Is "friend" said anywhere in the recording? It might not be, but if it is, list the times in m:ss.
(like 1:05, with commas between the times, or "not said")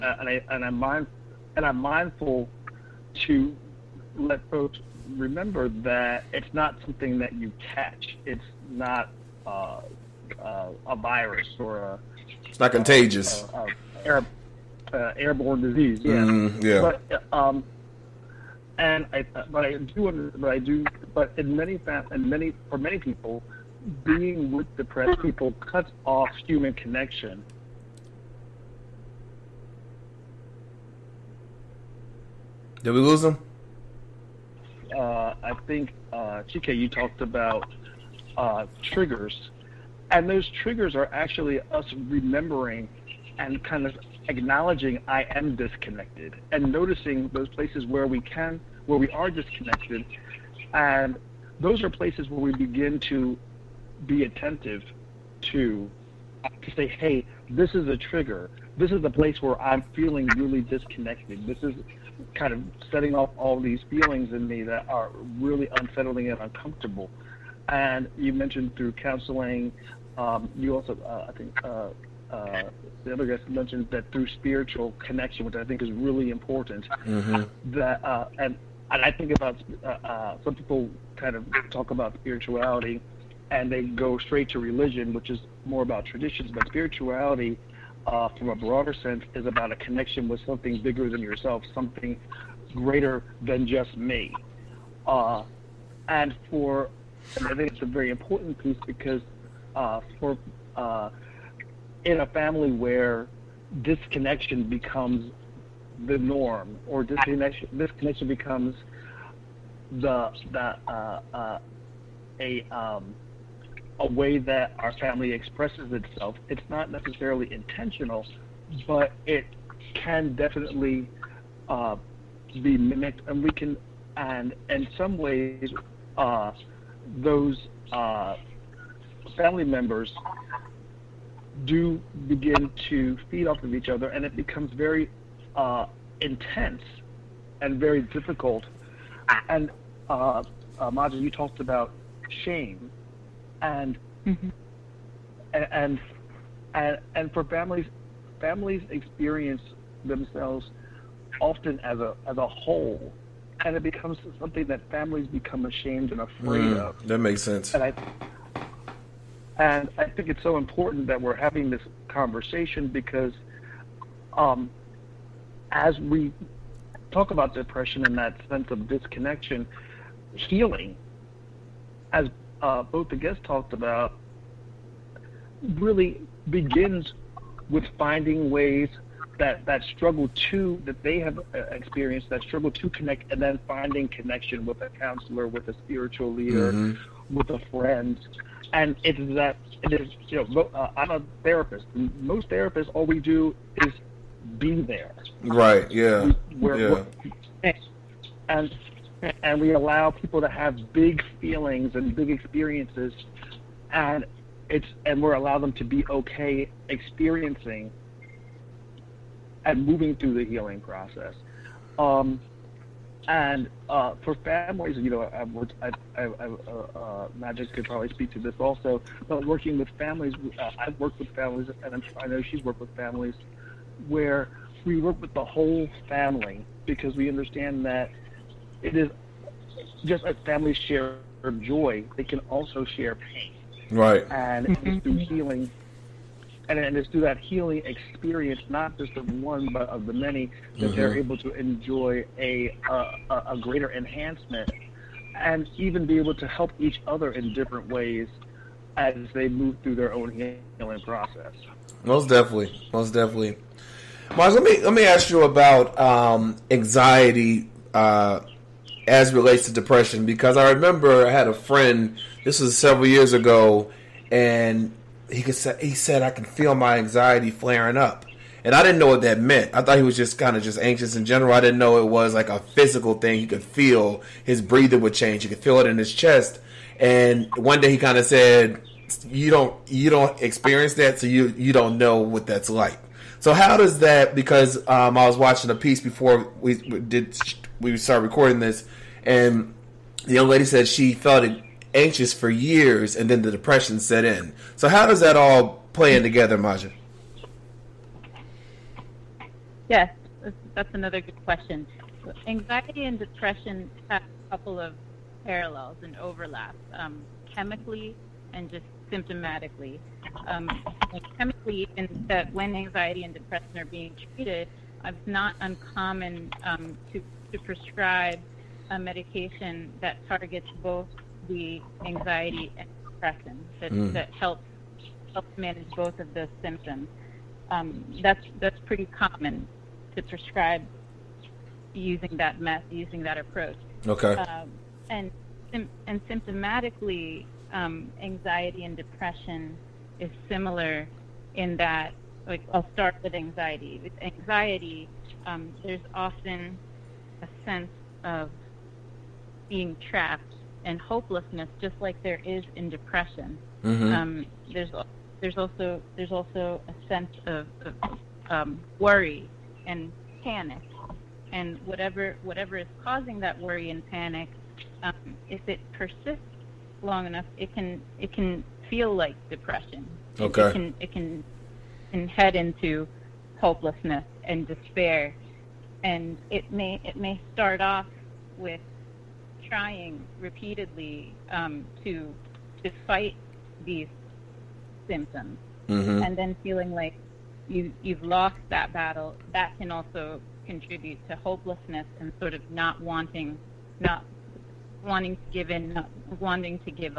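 3:07, 4:21.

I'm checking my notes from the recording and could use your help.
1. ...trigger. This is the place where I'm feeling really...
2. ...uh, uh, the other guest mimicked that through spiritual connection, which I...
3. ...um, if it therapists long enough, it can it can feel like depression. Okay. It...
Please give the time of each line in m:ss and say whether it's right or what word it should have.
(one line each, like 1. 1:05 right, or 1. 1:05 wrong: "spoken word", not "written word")
1. 0:57 right
2. 1:11 wrong: "mentioned", not "mimicked"
3. 6:05 wrong: "persists", not "therapists".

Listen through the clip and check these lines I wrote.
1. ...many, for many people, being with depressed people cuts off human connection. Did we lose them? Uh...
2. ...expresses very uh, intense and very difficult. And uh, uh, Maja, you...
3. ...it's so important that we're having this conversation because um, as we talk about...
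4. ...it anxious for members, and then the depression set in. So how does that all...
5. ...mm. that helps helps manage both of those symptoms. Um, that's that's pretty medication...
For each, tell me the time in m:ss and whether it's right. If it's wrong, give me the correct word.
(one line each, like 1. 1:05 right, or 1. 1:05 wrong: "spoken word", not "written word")
1. 0:22 right
2. 2:14 wrong: "becomes", not "expresses"
3. 2:40 right
4. 4:51 wrong: "years", not "members"
5. 5:23 wrong: "common", not "medication".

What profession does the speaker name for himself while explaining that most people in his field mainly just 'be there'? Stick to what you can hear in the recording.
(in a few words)
Therapist.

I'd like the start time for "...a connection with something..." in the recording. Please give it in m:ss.
1:29.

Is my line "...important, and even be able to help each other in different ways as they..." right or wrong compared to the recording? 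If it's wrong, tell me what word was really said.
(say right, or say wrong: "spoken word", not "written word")
wrong: "enhancement", not "important".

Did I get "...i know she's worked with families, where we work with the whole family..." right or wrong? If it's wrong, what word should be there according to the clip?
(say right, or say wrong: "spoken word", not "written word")
right.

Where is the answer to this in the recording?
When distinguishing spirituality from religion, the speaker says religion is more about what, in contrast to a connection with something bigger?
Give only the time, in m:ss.
1:26.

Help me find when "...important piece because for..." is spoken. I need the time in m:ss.
1:38.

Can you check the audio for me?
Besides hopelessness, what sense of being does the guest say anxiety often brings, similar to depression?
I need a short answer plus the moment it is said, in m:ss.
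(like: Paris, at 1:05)
Trapped, at 5:50.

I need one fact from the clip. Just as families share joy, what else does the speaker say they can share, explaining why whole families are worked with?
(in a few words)
Pain.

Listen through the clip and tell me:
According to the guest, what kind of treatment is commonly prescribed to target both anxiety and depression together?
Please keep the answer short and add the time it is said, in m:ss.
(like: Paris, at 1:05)
Medication, at 5:18.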